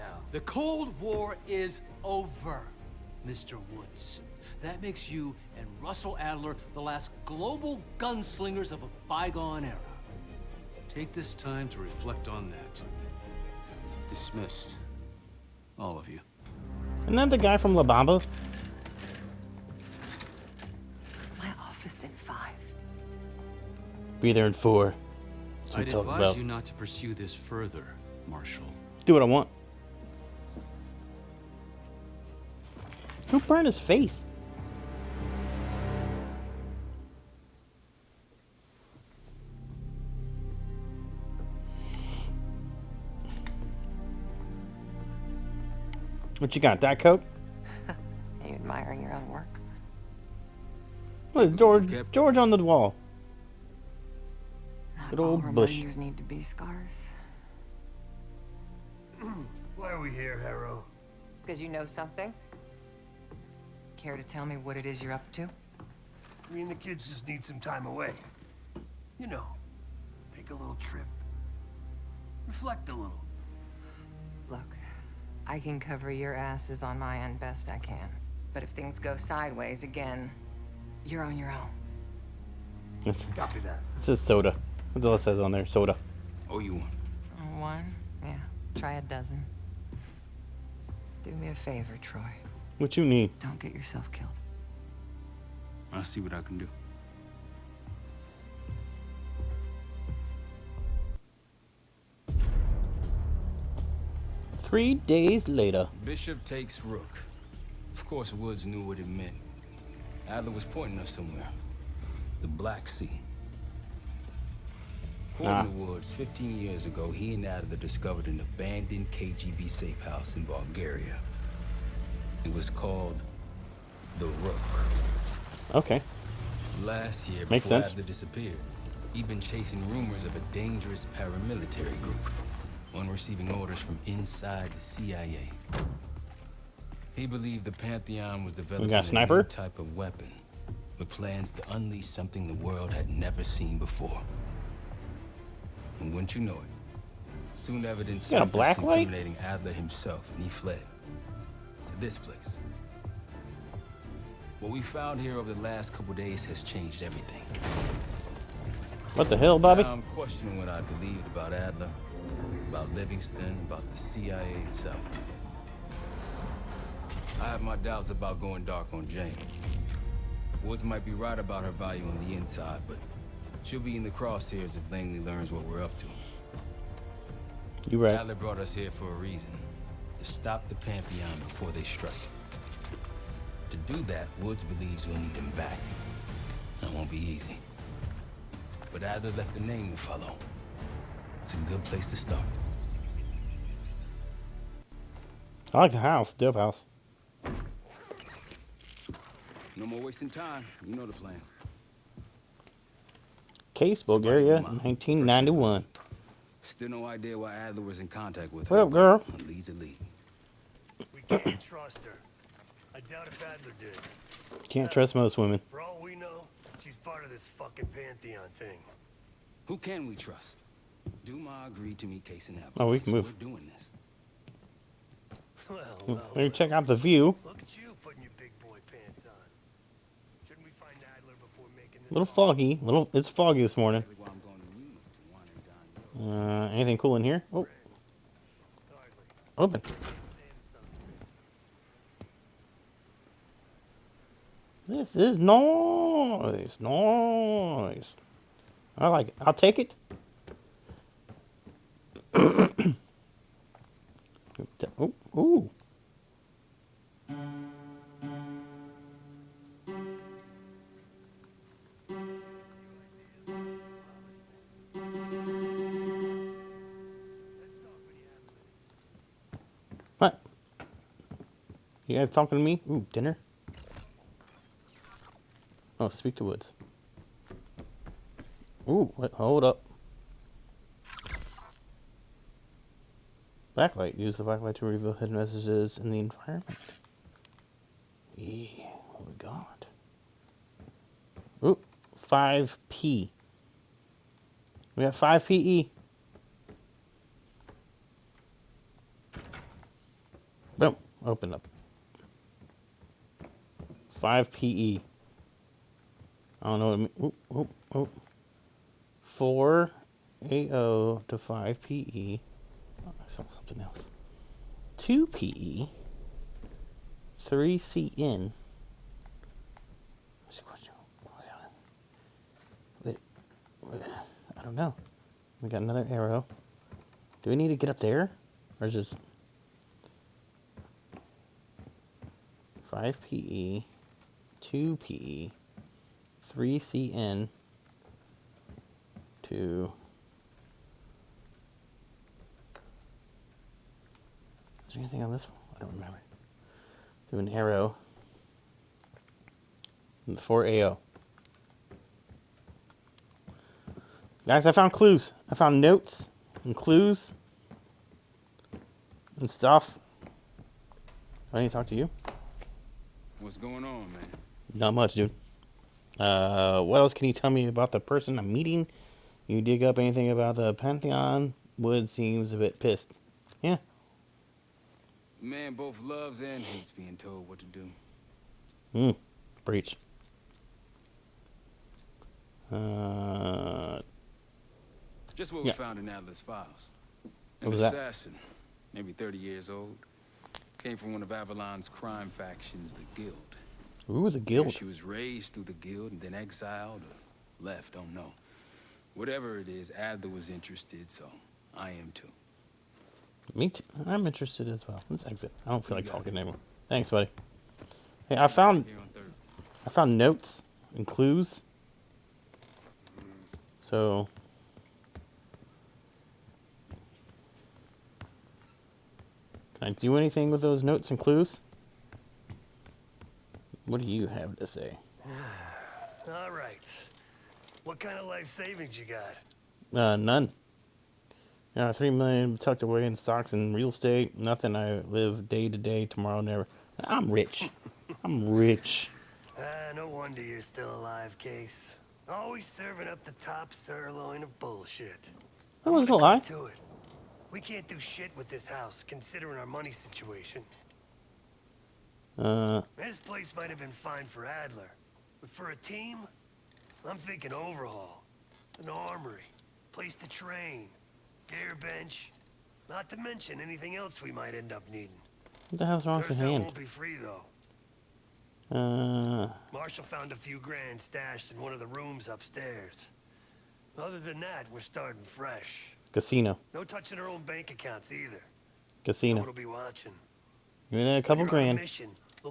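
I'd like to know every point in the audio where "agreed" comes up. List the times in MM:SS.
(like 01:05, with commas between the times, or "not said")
03:41.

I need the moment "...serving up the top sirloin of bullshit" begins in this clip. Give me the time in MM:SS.
07:22.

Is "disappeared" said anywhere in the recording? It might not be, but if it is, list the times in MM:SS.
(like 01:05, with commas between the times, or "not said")
02:08.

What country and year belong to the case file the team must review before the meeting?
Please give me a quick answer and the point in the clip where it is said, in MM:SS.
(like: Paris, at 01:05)
Bulgaria, 1991, at 03:24.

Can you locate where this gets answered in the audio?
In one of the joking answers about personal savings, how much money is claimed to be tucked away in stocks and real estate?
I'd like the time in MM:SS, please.
07:11.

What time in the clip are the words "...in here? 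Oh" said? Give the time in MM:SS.
03:57.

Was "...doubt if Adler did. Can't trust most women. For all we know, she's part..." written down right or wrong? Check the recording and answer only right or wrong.
right.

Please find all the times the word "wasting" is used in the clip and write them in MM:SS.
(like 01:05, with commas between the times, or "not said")
03:20.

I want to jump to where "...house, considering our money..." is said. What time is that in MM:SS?
07:28.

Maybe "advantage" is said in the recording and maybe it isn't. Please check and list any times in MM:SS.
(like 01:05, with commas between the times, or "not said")
not said.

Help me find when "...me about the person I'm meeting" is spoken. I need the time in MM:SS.
06:07.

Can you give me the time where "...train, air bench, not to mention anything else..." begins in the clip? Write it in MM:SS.
07:40.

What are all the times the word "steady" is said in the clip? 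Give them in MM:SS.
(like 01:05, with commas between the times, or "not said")
not said.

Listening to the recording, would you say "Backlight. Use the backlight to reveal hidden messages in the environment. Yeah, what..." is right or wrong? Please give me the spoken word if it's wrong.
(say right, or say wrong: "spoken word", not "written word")
right.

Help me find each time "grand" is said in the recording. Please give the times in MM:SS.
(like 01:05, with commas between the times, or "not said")
07:50, 08:01.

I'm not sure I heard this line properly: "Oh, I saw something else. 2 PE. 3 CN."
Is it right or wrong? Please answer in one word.
right.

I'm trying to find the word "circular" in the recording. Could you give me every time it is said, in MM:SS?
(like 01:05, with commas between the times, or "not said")
not said.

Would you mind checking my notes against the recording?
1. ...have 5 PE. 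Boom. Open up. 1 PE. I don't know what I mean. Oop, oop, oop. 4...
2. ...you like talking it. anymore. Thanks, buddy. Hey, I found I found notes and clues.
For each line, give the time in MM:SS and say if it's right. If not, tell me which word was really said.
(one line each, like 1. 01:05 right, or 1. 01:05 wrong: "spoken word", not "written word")
1. 04:55 wrong: "5", not "1"
2. 06:45 right.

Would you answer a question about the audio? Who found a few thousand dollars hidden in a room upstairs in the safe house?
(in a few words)
Marshall.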